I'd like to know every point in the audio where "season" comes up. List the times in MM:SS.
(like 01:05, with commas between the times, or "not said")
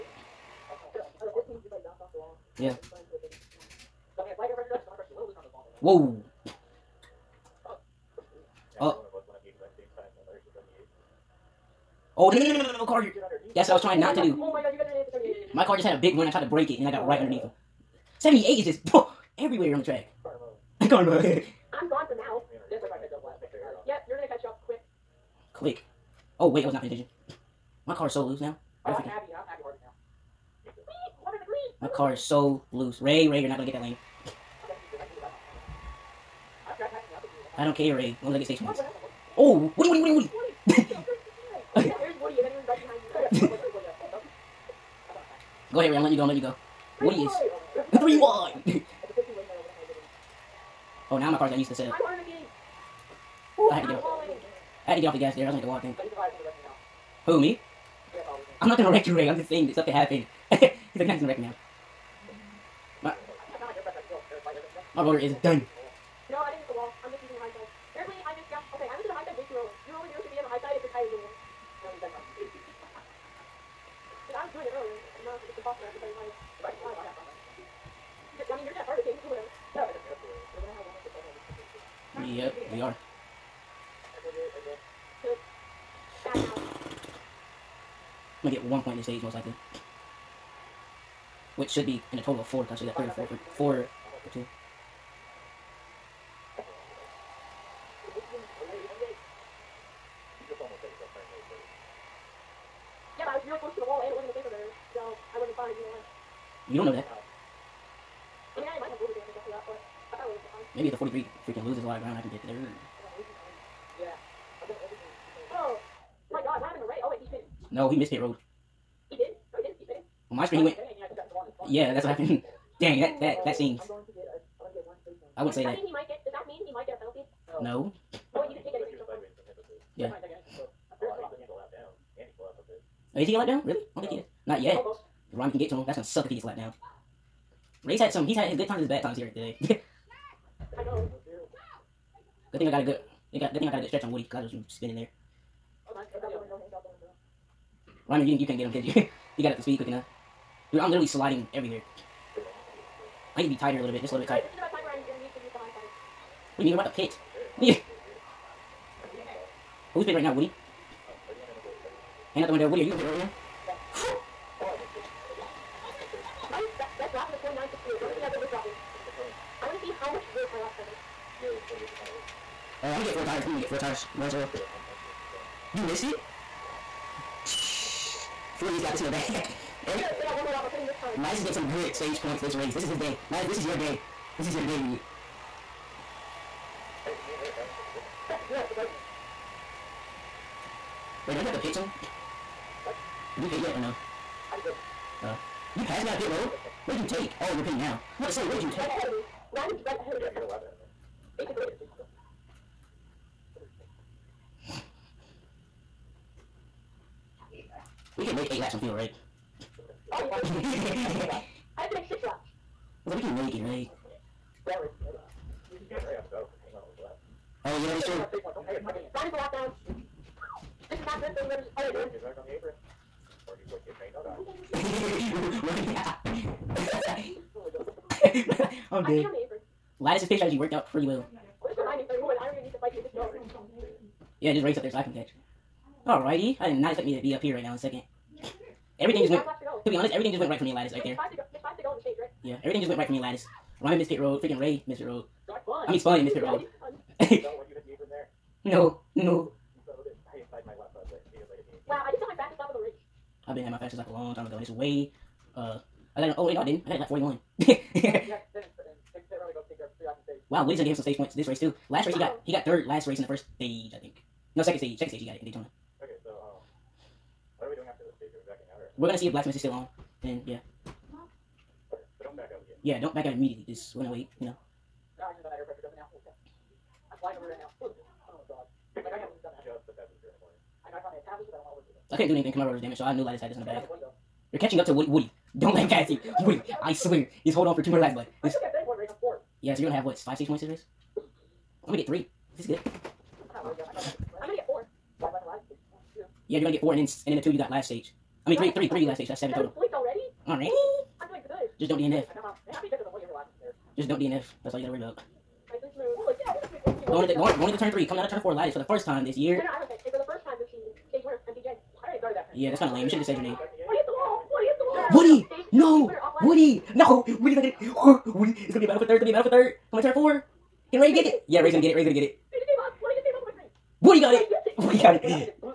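05:10.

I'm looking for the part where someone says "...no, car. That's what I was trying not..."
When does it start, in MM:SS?
00:12.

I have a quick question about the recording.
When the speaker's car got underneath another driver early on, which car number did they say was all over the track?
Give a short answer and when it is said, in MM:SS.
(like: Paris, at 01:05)
78, at 00:18.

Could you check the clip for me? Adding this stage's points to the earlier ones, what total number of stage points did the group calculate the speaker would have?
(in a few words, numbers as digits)
7.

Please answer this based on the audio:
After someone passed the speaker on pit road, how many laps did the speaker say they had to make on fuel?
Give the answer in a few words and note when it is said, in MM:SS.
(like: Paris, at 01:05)
6, at 03:32.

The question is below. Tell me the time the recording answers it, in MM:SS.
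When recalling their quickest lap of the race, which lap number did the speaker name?
04:16.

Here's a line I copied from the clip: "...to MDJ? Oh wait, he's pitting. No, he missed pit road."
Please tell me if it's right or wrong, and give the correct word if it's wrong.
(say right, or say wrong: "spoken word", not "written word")
wrong: "Ray", not "MDJ".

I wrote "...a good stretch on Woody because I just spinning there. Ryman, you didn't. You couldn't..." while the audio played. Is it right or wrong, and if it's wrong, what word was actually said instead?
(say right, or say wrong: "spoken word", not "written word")
right.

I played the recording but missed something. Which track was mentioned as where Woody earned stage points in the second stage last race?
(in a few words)
Daytona.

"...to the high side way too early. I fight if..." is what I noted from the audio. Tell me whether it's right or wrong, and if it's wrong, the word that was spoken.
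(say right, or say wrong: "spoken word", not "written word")
right.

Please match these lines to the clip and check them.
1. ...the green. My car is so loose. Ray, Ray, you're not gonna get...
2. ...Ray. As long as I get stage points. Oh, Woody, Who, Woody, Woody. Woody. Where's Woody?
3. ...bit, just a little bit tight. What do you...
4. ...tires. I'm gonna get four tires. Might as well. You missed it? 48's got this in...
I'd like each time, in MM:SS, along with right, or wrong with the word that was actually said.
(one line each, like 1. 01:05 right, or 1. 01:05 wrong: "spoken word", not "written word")
1. 00:31 right
2. 00:37 wrong: "Woody", not "Who"
3. 02:33 right
4. 02:53 right.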